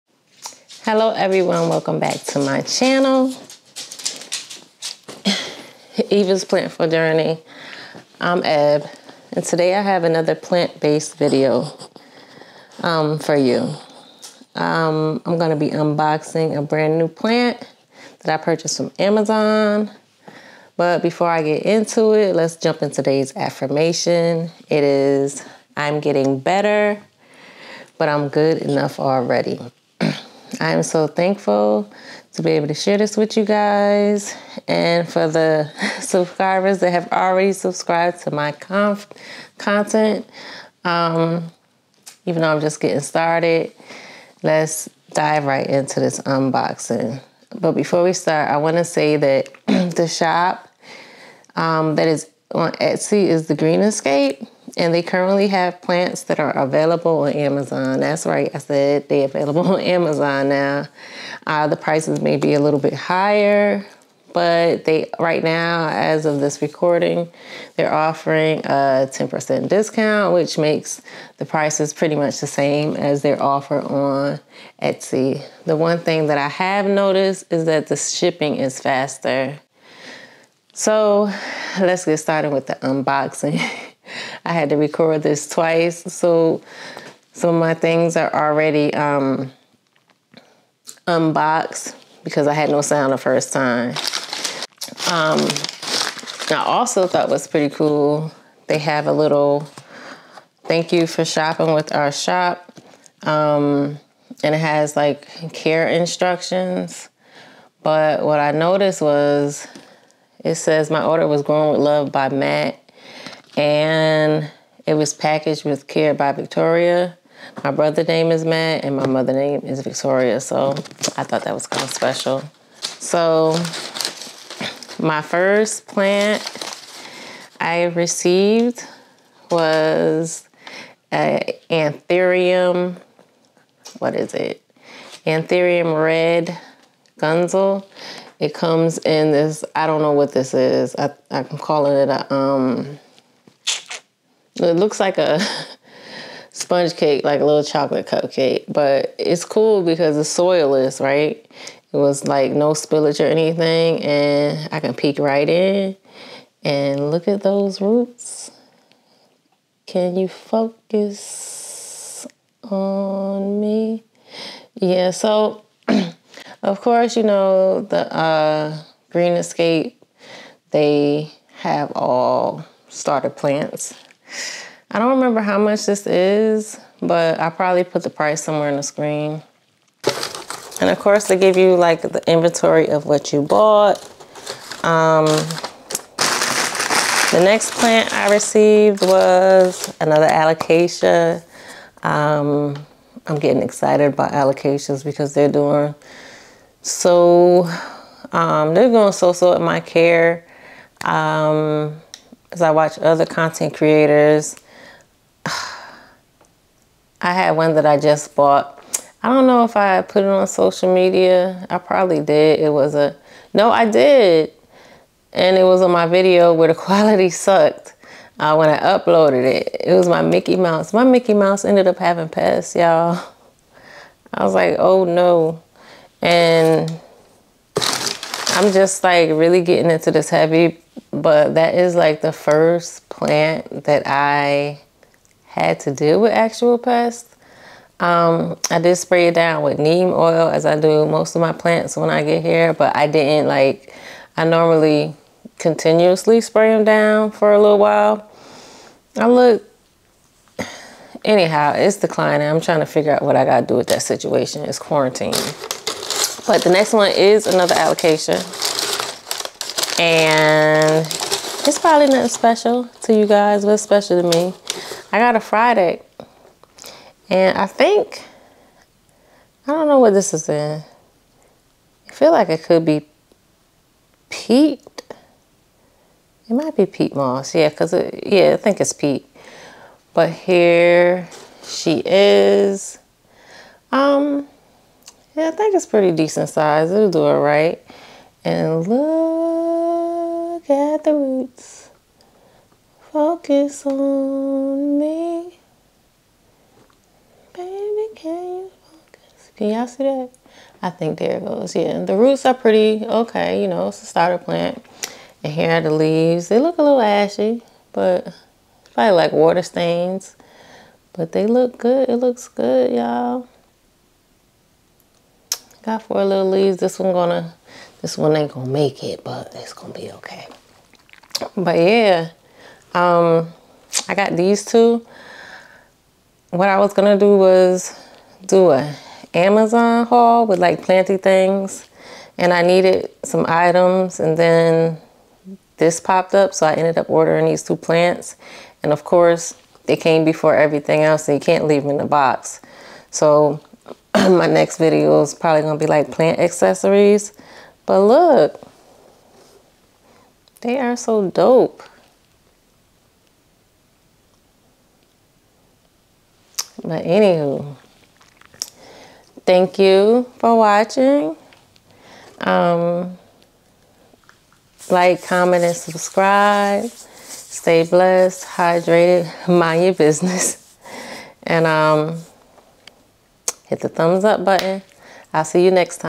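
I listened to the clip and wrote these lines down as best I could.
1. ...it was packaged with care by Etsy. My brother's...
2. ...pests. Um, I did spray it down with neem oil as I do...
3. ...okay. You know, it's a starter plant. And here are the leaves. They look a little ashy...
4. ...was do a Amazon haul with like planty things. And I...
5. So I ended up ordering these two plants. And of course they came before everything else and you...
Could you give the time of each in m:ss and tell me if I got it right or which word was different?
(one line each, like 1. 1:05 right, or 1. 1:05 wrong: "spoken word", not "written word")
1. 1:54 wrong: "Victoria", not "Etsy"
2. 3:56 right
3. 5:03 right
4. 5:27 right
5. 5:36 right.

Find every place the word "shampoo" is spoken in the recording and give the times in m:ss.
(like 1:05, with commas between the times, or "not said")
not said.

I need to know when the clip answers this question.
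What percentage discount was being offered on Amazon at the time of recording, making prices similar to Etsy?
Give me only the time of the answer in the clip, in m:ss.
1:09.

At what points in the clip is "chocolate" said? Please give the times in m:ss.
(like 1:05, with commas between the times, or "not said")
2:27.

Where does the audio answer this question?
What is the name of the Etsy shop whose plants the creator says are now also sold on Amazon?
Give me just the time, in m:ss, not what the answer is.
0:53.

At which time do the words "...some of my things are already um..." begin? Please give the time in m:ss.
1:27.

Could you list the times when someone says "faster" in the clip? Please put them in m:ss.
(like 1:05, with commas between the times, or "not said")
1:18.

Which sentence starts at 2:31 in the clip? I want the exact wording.
It was like no spillage or anything, and I can peek right in and look at those roots.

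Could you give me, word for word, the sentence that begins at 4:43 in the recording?
Um, yeah, I think it's pretty decent size.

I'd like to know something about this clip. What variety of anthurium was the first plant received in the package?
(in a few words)
Red gunsal.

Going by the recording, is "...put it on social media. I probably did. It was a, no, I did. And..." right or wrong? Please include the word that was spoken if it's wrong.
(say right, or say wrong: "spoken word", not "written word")
right.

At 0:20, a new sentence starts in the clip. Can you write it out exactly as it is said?
But before I get into it, let's jump into today's affirmation.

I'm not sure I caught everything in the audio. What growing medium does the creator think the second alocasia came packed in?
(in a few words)
Peat moss.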